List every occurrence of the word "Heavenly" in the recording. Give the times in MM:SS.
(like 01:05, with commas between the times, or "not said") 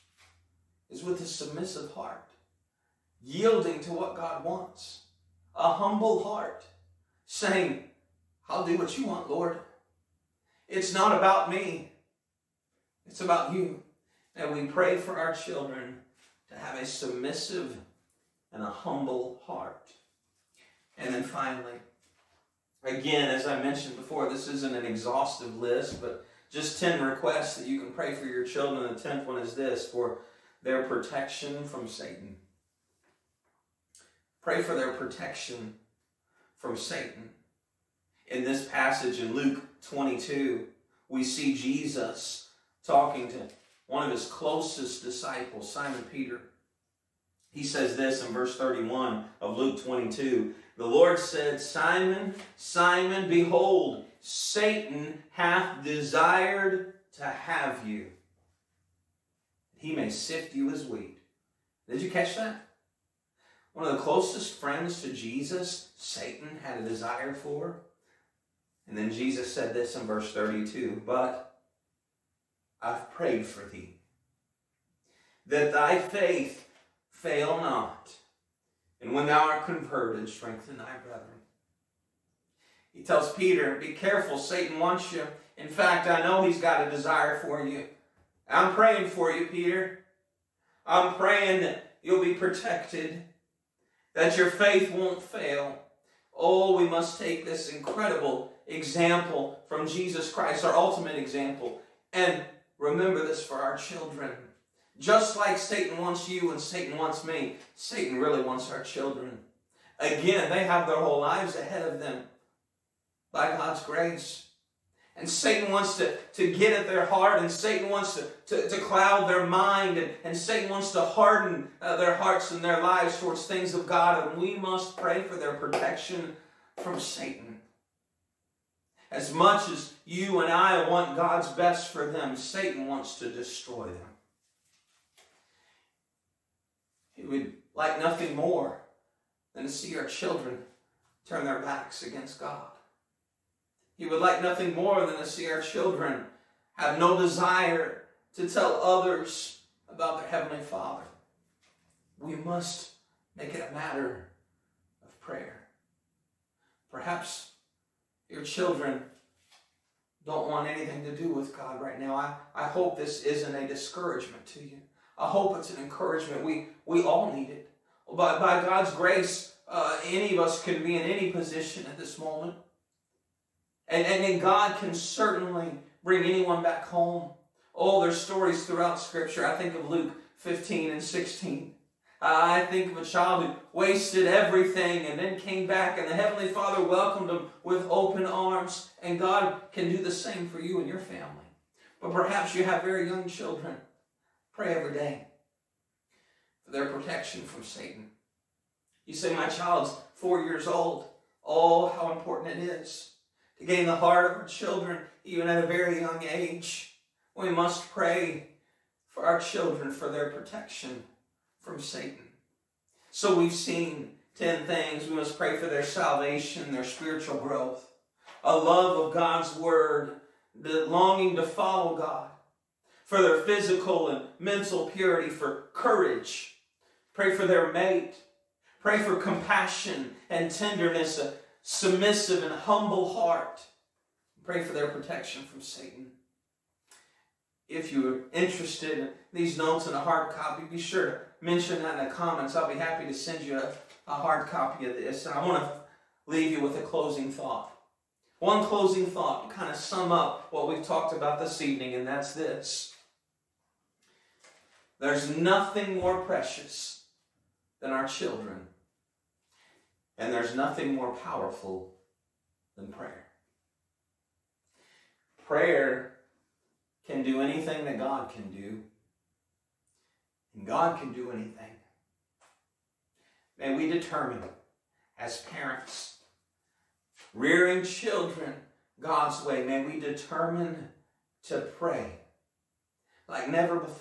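02:30, 03:06.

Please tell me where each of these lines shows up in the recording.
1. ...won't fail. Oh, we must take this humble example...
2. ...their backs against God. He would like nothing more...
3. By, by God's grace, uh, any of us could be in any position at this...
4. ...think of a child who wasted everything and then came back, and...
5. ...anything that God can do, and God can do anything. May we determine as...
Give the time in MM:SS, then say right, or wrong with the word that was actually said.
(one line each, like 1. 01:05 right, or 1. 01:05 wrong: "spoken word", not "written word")
1. 01:34 wrong: "incredible", not "humble"
2. 02:21 right
3. 02:48 right
4. 03:02 right
5. 04:27 right.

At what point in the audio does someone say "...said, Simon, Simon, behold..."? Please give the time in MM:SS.
00:51.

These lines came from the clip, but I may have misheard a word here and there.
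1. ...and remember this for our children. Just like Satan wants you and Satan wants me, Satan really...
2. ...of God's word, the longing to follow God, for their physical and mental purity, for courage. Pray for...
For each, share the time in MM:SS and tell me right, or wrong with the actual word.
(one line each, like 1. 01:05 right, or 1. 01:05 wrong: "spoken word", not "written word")
1. 01:42 right
2. 03:39 right.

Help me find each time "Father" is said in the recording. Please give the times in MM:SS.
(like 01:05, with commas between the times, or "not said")
02:30, 03:06.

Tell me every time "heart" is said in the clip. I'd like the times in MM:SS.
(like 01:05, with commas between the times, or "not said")
00:01, 00:06, 00:19, 01:57, 02:02, 03:23, 03:53.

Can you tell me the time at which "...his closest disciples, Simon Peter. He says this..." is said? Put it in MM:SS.
00:44.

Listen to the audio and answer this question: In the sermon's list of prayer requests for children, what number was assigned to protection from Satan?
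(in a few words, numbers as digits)
10.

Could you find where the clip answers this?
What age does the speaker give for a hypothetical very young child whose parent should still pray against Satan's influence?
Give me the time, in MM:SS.
03:20.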